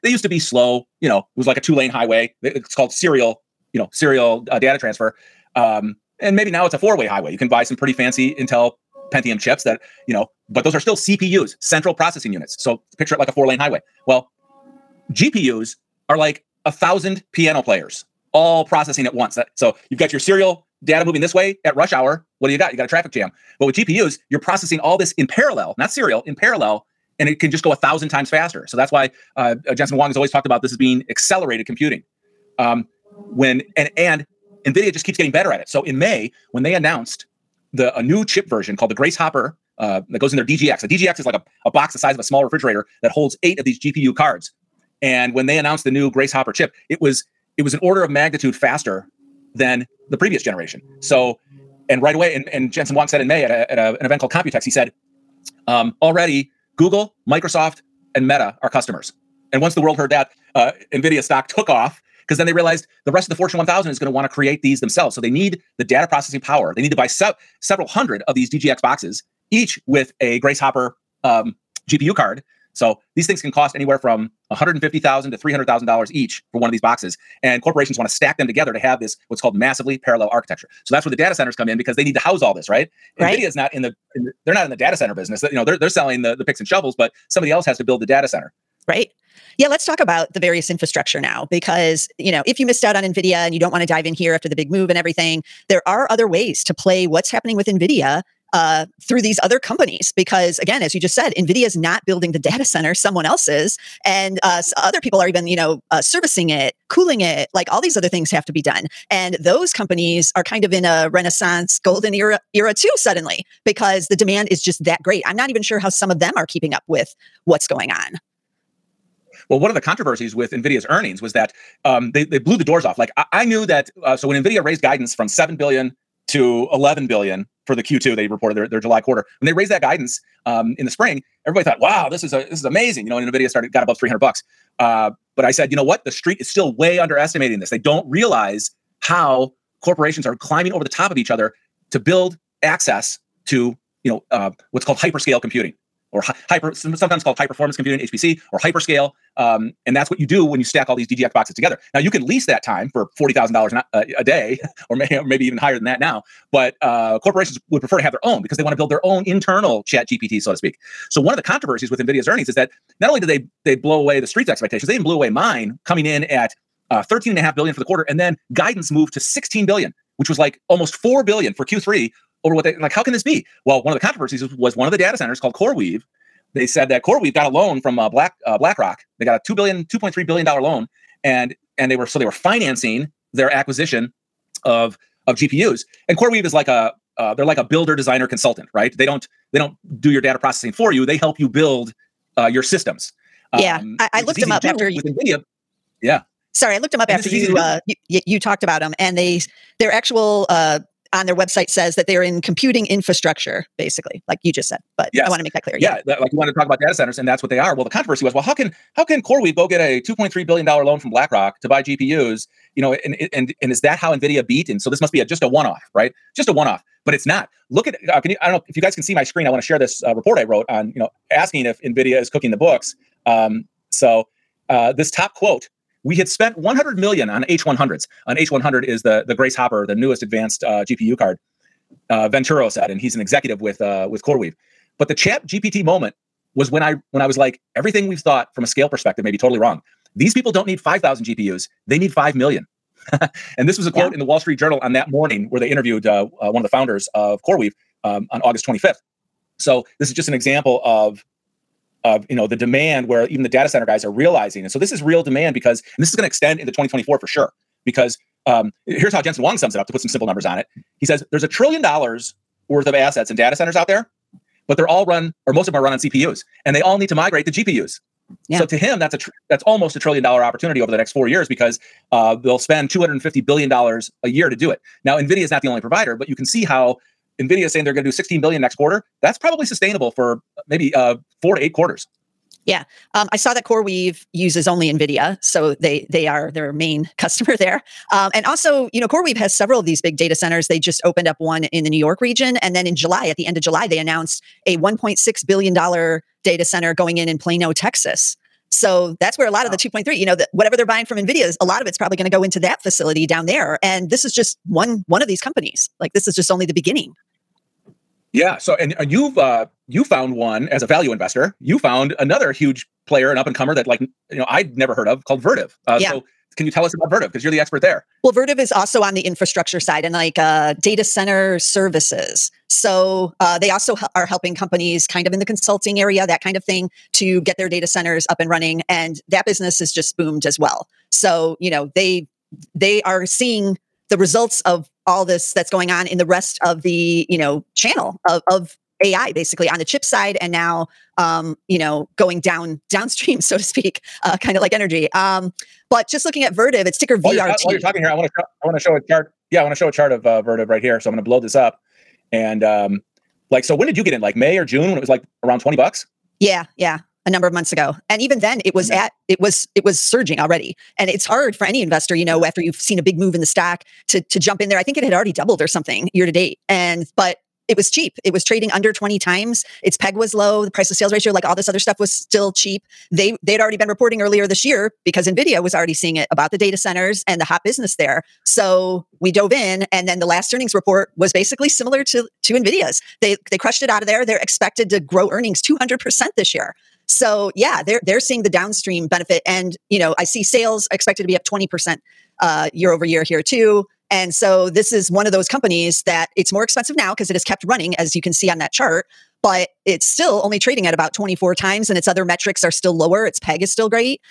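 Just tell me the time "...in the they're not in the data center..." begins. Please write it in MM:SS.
01:24.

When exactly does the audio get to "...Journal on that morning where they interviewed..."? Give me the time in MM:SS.
04:04.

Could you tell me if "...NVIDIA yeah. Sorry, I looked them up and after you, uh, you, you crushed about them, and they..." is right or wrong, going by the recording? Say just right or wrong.
wrong.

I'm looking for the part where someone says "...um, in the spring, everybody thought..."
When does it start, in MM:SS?
02:10.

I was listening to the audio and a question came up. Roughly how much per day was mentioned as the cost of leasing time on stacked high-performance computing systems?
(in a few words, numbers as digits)
$40,000.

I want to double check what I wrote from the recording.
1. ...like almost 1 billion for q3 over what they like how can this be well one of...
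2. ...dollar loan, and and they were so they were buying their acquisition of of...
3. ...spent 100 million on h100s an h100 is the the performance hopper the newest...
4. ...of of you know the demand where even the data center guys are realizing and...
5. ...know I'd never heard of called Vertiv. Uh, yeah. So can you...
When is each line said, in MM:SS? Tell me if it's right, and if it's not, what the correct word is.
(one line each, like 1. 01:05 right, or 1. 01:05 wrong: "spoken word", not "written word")
1. 02:50 wrong: "4", not "1"
2. 03:00 wrong: "financing", not "buying"
3. 03:46 wrong: "grace", not "performance"
4. 04:10 right
5. 05:14 right.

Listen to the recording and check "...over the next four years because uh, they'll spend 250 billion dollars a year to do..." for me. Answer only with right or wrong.
right.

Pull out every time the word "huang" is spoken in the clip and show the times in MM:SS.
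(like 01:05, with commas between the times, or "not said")
00:29, 00:52, 04:19.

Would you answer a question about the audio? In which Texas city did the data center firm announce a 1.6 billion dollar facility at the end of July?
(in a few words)
Plano.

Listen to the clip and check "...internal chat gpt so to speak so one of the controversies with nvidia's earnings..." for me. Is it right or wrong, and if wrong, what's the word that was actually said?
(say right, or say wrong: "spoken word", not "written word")
right.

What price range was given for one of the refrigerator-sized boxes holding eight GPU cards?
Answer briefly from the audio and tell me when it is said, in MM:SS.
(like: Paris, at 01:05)
$150,000 to $300,000, at 01:14.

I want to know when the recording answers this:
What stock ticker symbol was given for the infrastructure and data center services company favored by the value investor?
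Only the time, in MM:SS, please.
05:47.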